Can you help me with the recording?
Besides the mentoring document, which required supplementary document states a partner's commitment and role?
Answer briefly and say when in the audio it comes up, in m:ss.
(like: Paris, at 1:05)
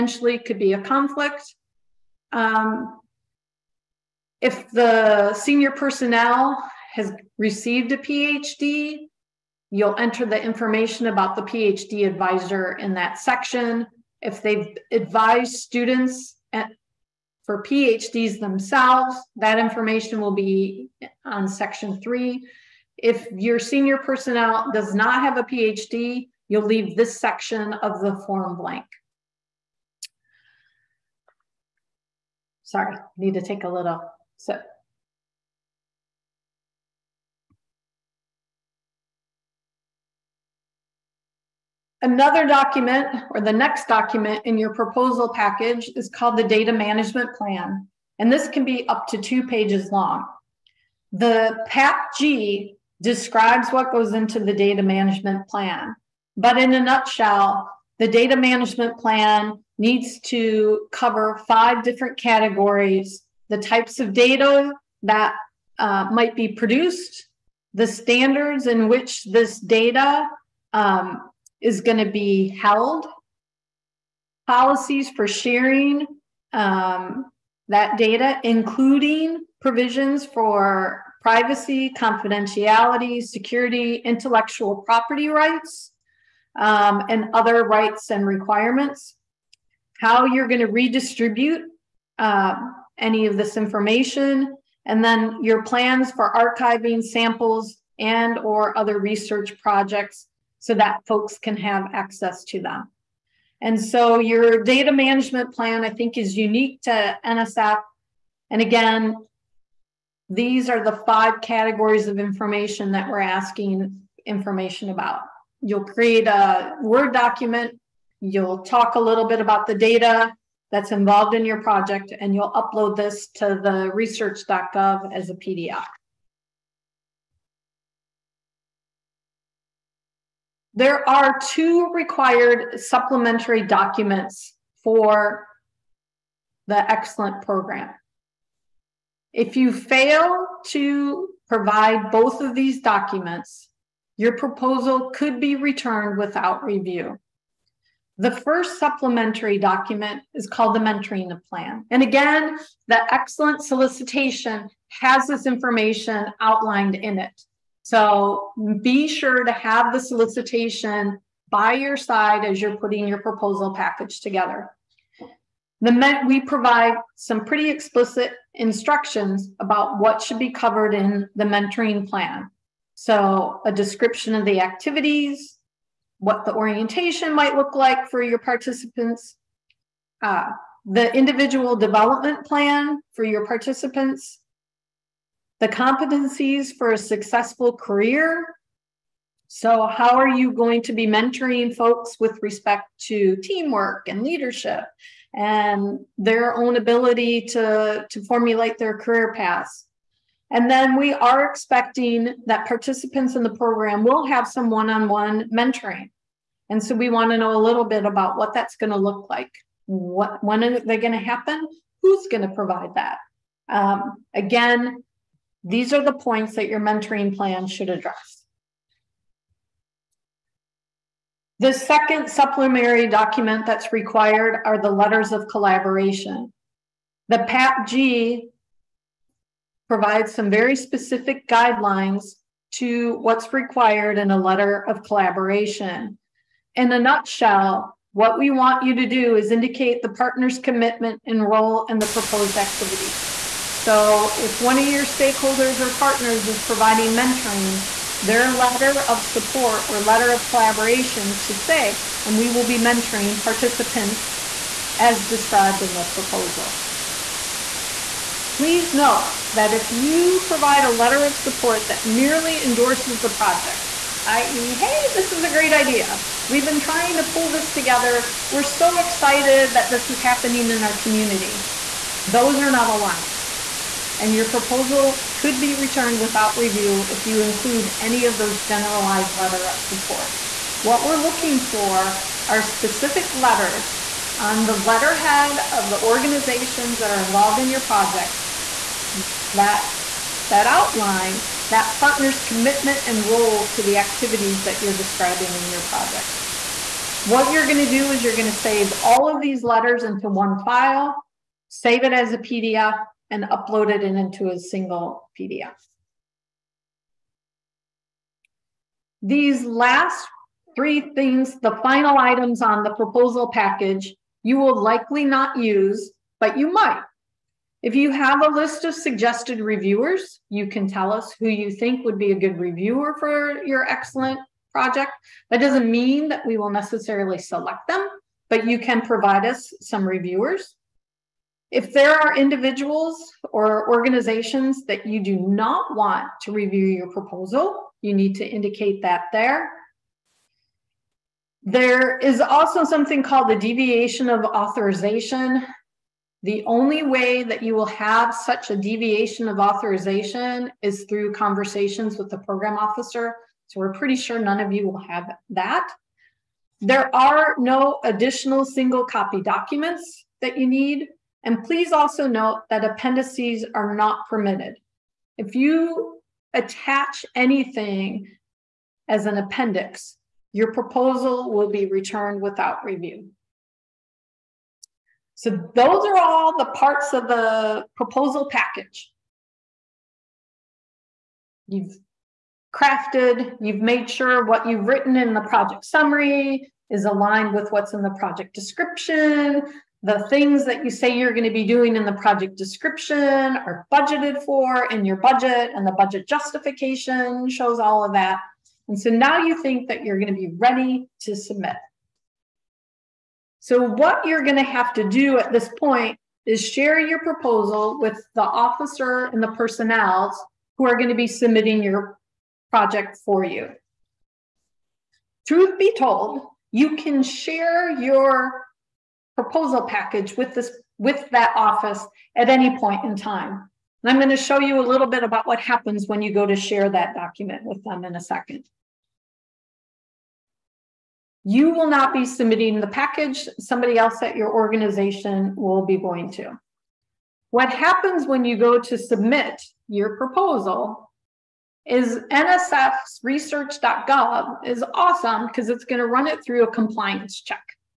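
Letters of collaboration, at 3:44.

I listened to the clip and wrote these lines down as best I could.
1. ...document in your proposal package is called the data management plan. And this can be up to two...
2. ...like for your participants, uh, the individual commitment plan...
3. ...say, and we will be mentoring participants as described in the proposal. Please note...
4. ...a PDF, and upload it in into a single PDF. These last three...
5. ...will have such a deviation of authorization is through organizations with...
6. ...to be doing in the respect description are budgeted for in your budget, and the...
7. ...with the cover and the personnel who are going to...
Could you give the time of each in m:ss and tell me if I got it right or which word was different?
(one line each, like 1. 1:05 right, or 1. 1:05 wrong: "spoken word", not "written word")
1. 0:43 right
2. 2:57 wrong: "development", not "commitment"
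3. 4:11 right
4. 5:02 right
5. 5:47 wrong: "conversations", not "organizations"
6. 6:31 wrong: "project", not "respect"
7. 6:47 wrong: "officer", not "cover".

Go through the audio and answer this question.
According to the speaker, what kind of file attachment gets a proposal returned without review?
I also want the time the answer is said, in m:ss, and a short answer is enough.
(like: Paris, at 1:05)
Appendices, at 6:02.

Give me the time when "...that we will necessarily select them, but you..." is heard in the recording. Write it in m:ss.
5:26.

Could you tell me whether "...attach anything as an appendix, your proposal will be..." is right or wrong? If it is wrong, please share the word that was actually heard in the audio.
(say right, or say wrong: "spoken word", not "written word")
right.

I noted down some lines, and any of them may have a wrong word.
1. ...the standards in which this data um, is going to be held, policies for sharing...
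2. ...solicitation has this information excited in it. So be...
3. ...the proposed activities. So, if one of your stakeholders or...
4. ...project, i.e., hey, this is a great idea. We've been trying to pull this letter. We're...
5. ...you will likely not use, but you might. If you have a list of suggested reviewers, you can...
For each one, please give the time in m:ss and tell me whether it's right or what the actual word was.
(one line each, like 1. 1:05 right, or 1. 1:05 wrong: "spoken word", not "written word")
1. 1:07 right
2. 2:33 wrong: "outlined", not "excited"
3. 4:01 right
4. 4:23 wrong: "together", not "letter"
5. 5:14 right.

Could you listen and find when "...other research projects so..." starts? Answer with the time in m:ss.
1:38.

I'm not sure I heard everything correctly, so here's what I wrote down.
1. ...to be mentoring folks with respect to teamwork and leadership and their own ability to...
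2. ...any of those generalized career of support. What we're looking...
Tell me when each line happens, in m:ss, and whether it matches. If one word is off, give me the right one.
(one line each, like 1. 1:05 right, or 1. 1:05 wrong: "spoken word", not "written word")
1. 3:10 right
2. 4:37 wrong: "letter", not "career".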